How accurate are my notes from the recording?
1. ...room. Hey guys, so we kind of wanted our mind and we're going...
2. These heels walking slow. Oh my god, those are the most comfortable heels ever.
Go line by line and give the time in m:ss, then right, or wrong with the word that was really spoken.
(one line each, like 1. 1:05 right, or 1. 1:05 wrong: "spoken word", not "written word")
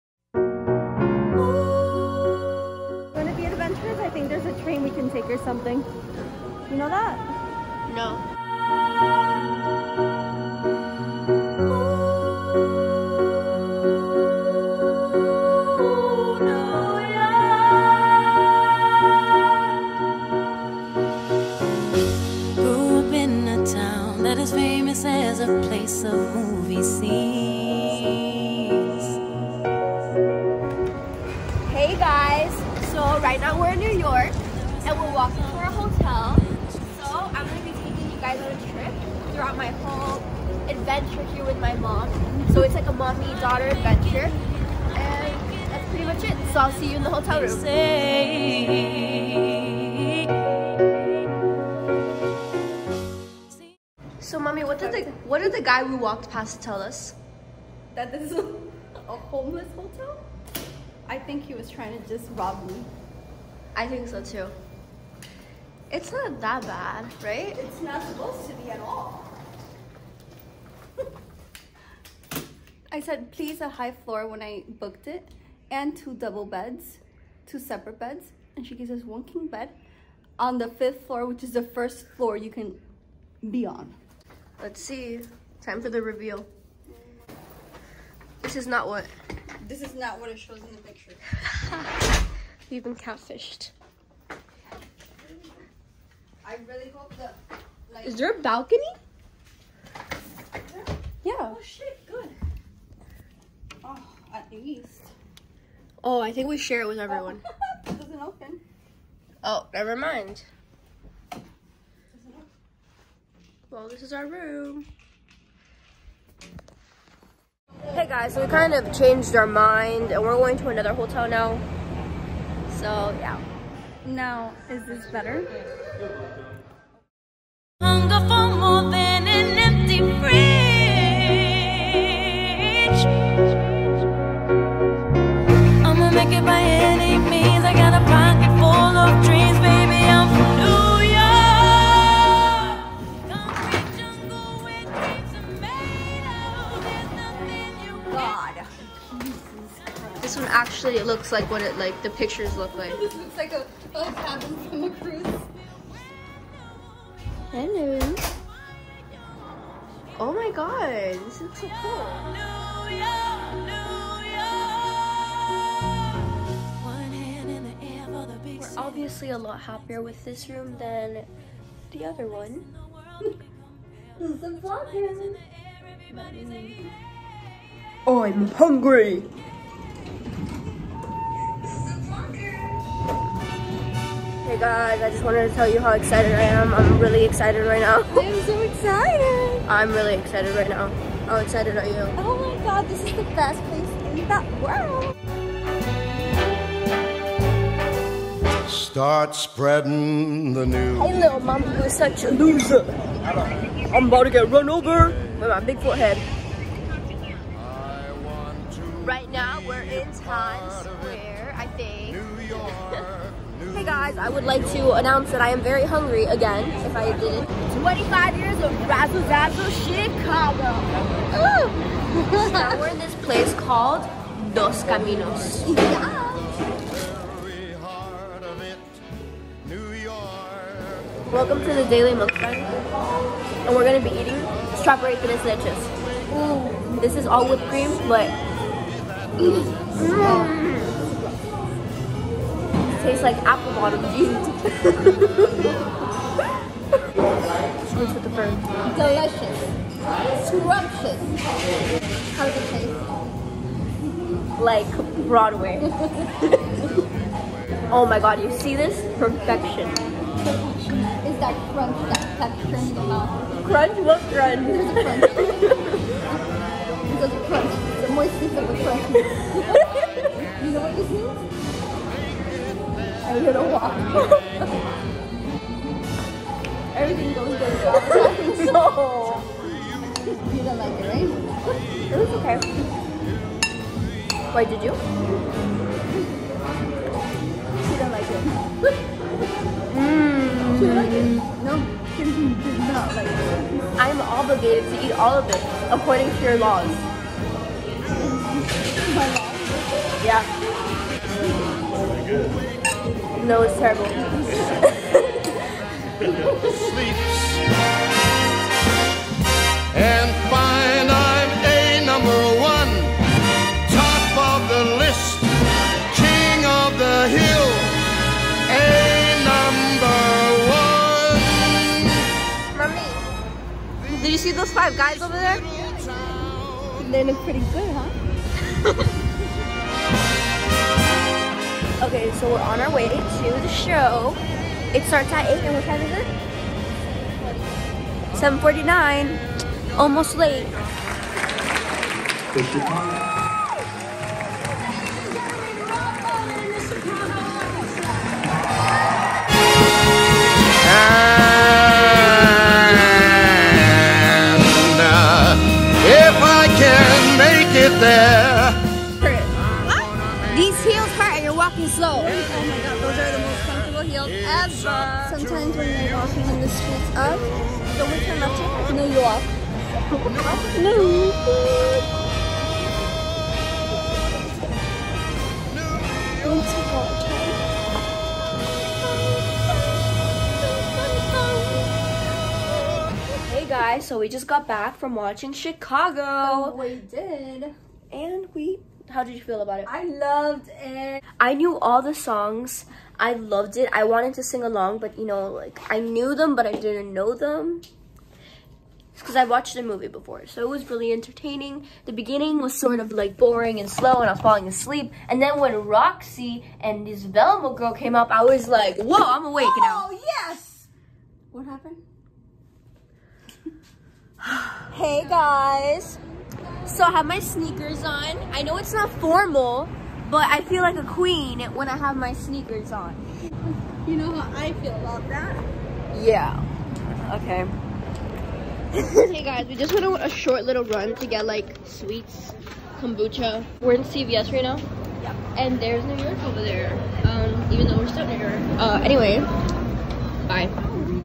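1. 1:54 wrong: "changed", not "wanted"
2. 6:00 right.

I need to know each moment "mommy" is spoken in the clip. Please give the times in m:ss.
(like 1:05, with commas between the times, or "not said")
0:42, 0:54, 5:22.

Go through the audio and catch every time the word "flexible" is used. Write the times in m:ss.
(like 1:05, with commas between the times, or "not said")
not said.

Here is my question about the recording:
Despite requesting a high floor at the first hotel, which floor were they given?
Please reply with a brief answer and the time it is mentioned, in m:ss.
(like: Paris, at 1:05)
5th floor, at 1:20.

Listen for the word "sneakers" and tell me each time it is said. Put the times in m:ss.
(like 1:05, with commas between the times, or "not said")
6:57, 7:02.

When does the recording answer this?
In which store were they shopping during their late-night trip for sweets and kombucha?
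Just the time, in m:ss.
7:14.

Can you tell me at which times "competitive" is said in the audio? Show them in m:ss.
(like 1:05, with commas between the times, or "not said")
not said.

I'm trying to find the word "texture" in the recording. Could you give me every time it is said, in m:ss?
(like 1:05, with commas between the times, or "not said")
4:22.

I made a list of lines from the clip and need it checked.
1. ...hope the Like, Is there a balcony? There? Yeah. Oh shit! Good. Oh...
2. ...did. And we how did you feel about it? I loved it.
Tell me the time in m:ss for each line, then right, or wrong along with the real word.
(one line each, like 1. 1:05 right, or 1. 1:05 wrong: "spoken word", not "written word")
1. 1:36 right
2. 6:27 right.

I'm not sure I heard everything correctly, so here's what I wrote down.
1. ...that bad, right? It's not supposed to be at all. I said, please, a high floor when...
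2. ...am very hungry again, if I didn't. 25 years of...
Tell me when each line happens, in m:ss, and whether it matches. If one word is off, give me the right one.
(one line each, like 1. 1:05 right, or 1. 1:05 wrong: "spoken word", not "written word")
1. 1:06 right
2. 3:35 right.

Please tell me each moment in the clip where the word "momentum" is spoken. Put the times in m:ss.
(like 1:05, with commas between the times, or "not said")
not said.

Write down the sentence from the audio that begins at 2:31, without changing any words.
looks like what it like the pictures look like.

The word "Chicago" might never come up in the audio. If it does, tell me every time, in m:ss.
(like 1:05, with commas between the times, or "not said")
3:39, 6:25.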